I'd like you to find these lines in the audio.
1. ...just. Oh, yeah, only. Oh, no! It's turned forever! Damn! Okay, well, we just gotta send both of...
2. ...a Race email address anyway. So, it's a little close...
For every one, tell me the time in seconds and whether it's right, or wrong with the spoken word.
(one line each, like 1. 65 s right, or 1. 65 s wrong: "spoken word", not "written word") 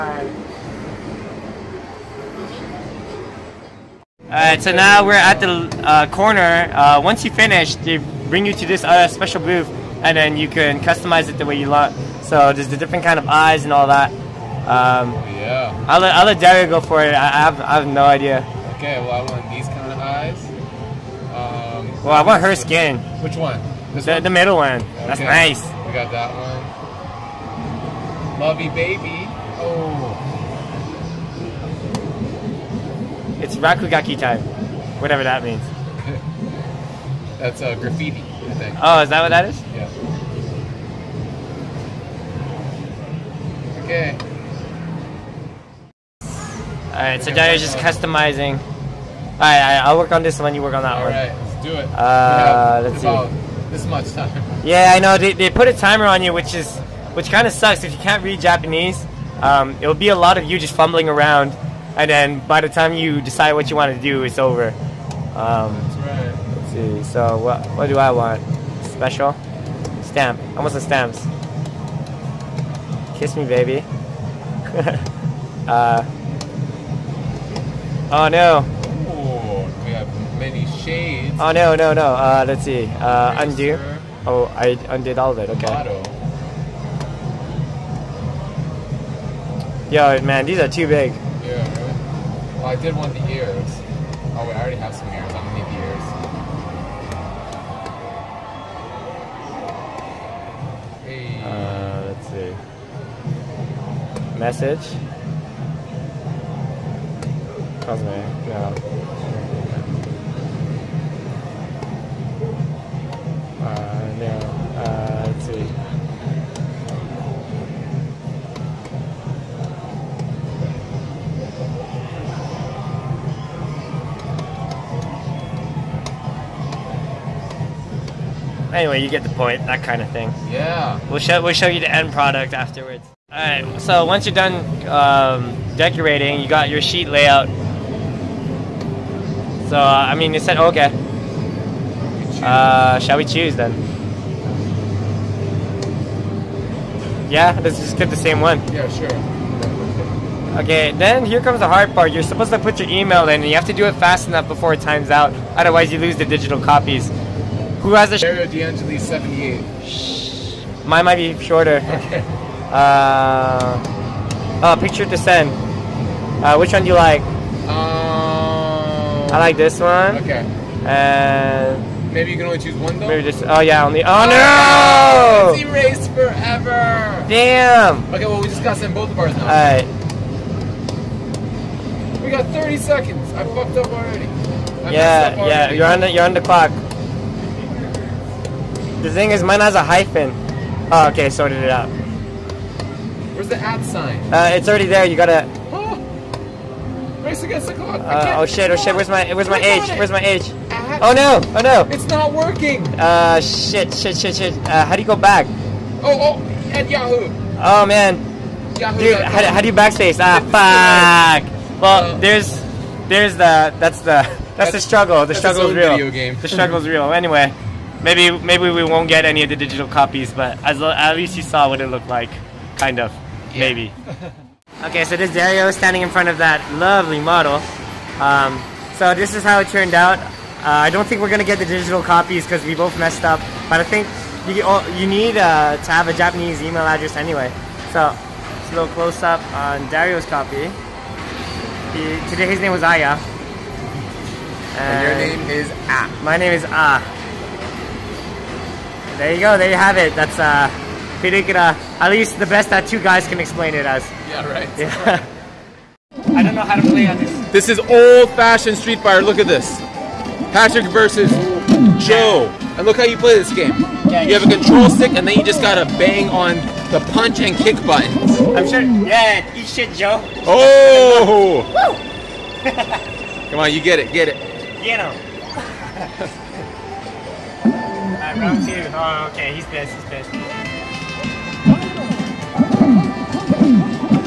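1. 173 s wrong: "erased", not "turned"
2. 236 s wrong: "Japanese", not "Race".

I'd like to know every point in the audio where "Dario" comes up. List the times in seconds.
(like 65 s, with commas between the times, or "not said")
225 s, 239 s.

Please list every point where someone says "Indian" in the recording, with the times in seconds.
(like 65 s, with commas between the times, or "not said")
not said.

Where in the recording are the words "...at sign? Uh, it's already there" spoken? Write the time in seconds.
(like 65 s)
193 s.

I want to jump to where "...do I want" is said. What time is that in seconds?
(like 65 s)
67 s.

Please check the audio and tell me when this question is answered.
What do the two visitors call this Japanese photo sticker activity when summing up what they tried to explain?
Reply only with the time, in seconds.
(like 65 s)
251 s.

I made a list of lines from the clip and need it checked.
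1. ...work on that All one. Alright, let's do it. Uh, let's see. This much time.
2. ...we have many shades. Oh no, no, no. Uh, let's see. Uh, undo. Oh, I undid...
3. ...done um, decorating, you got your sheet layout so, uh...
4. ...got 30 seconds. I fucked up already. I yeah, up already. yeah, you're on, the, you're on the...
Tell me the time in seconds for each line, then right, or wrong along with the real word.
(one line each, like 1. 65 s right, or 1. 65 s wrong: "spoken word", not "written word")
1. 50 s right
2. 79 s right
3. 134 s right
4. 182 s right.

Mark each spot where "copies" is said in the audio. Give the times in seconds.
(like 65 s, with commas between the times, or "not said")
156 s, 219 s, 232 s.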